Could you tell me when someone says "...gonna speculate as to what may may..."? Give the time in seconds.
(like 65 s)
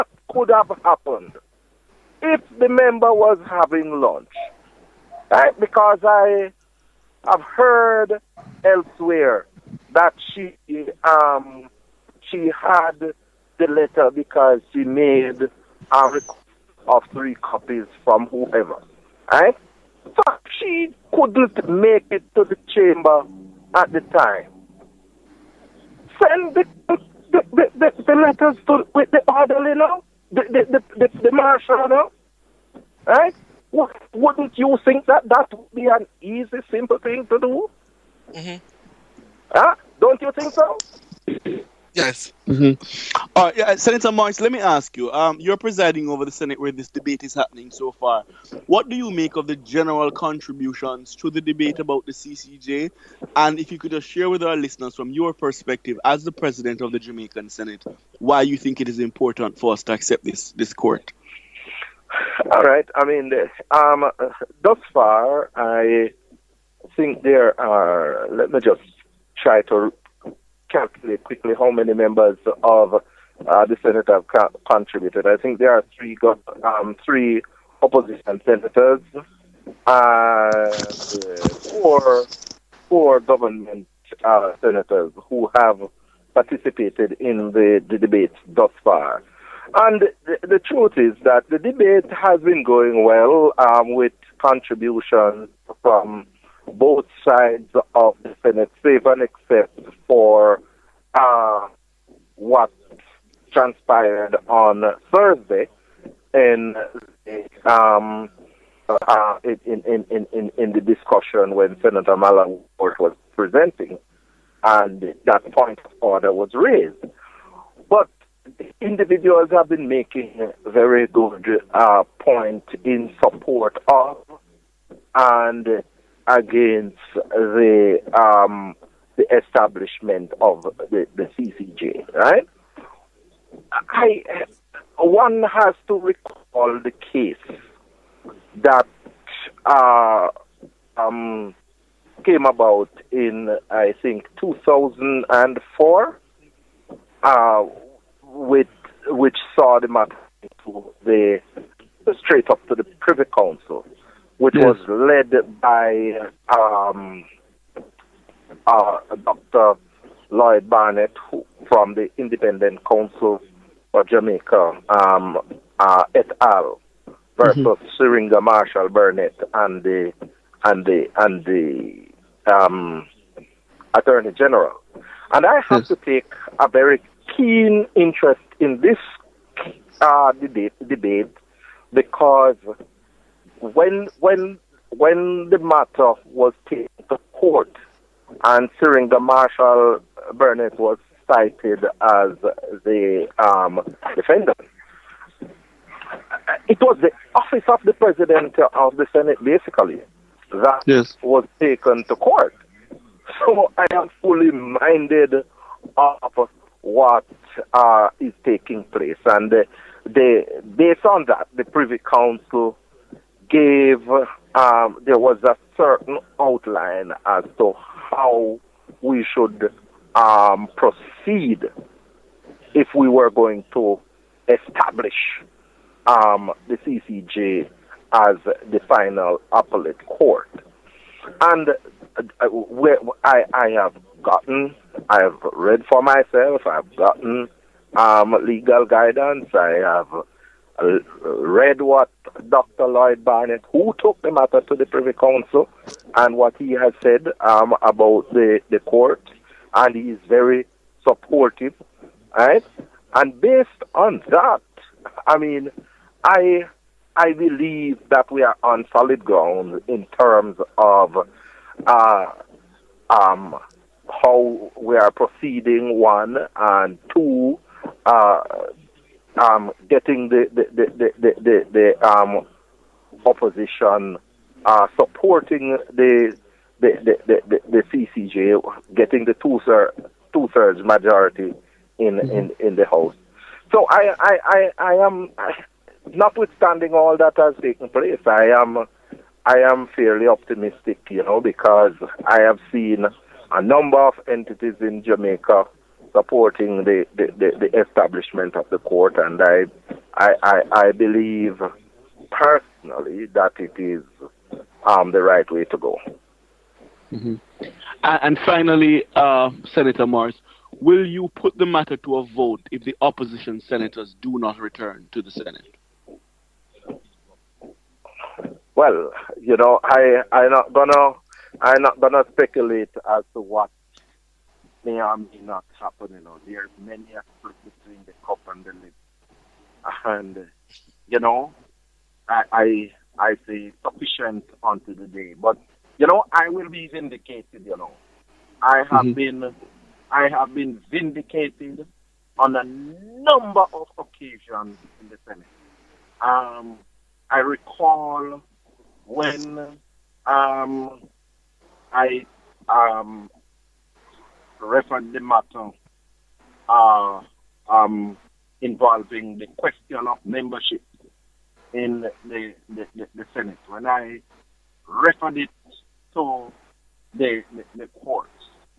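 321 s.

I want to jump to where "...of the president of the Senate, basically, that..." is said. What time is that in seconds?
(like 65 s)
197 s.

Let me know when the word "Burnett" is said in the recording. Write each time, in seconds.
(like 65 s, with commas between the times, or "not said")
168 s, 190 s.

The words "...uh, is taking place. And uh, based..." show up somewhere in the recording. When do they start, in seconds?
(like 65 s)
207 s.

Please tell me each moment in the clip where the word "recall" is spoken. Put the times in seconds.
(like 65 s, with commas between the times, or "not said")
135 s, 347 s.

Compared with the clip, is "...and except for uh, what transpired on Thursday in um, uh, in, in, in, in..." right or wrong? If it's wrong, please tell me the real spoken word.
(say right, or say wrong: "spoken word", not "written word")
right.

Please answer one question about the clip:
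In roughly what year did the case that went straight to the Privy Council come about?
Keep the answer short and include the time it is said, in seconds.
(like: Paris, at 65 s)
2004, at 144 s.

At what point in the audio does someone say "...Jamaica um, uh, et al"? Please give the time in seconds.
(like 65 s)
164 s.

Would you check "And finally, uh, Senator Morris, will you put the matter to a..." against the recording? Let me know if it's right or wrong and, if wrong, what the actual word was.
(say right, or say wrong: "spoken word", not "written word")
right.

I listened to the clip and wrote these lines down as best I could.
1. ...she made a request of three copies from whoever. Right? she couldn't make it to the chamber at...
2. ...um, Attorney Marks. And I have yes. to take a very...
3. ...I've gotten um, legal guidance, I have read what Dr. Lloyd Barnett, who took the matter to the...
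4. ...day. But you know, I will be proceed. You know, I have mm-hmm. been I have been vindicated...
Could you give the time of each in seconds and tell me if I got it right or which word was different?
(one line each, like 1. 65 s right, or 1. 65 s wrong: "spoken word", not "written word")
1. 14 s right
2. 172 s wrong: "General", not "Marks"
3. 236 s right
4. 335 s wrong: "vindicated", not "proceed".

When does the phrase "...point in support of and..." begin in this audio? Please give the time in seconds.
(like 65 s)
122 s.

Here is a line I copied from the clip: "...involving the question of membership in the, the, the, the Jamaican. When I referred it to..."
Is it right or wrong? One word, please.
wrong.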